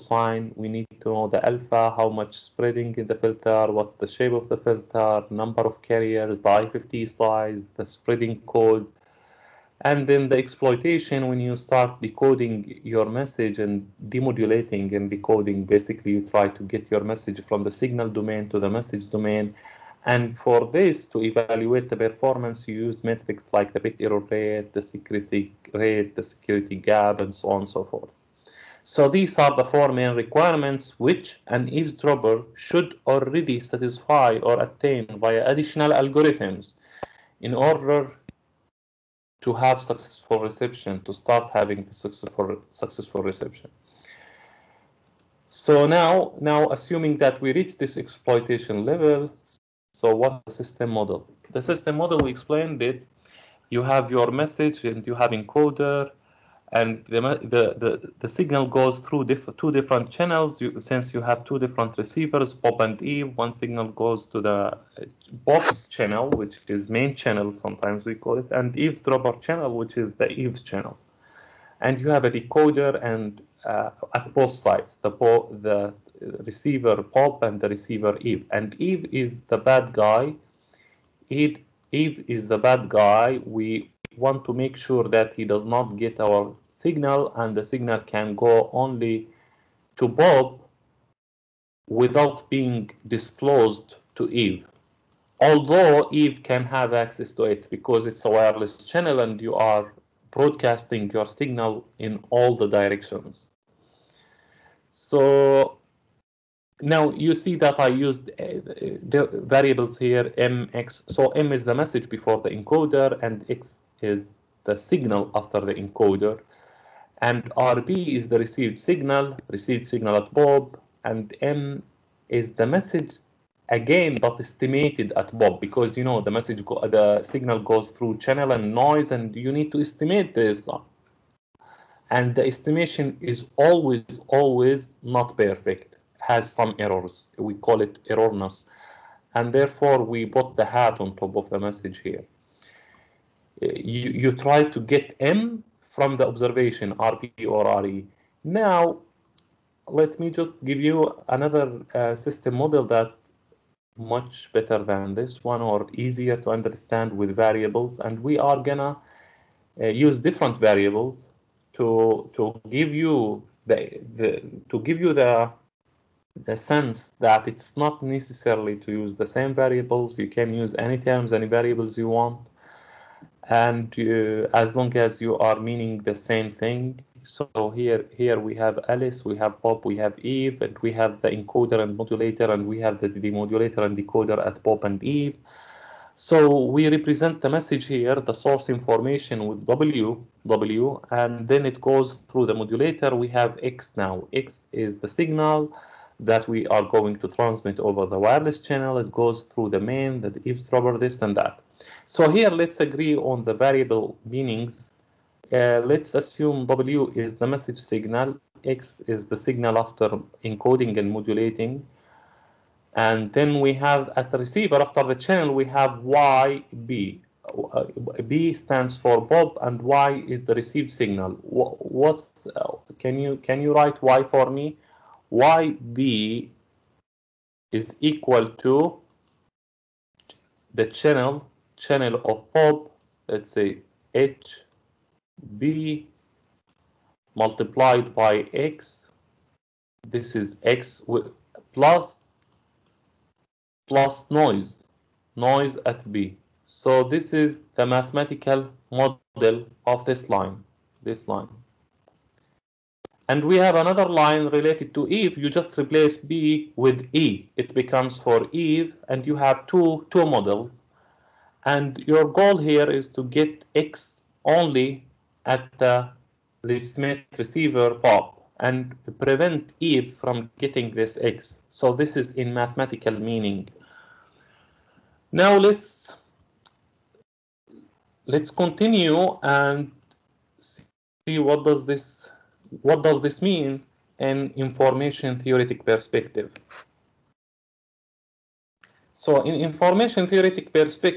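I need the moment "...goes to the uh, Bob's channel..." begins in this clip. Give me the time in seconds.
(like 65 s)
63 s.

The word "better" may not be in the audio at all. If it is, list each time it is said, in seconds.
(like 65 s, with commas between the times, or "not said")
154 s.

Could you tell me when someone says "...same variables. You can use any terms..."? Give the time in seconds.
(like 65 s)
169 s.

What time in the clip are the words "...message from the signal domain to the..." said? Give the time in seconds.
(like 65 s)
17 s.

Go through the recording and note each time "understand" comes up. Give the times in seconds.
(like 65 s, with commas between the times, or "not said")
156 s.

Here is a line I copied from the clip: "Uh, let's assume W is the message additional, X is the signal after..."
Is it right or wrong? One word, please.
wrong.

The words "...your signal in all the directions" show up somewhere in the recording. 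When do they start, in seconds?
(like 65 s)
101 s.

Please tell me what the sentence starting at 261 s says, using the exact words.
And your goal here is to get X only at the legitimate receiver Bob and prevent Eve from getting this X.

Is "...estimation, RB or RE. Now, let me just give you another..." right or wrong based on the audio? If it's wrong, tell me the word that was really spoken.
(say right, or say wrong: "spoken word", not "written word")
wrong: "observation", not "estimation".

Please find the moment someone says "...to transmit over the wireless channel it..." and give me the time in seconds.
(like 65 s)
197 s.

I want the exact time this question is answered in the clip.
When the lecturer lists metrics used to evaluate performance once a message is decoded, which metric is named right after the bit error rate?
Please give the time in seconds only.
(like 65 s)
24 s.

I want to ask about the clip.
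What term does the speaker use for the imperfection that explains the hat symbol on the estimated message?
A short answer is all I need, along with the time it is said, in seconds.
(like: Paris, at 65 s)
Errorness, at 138 s.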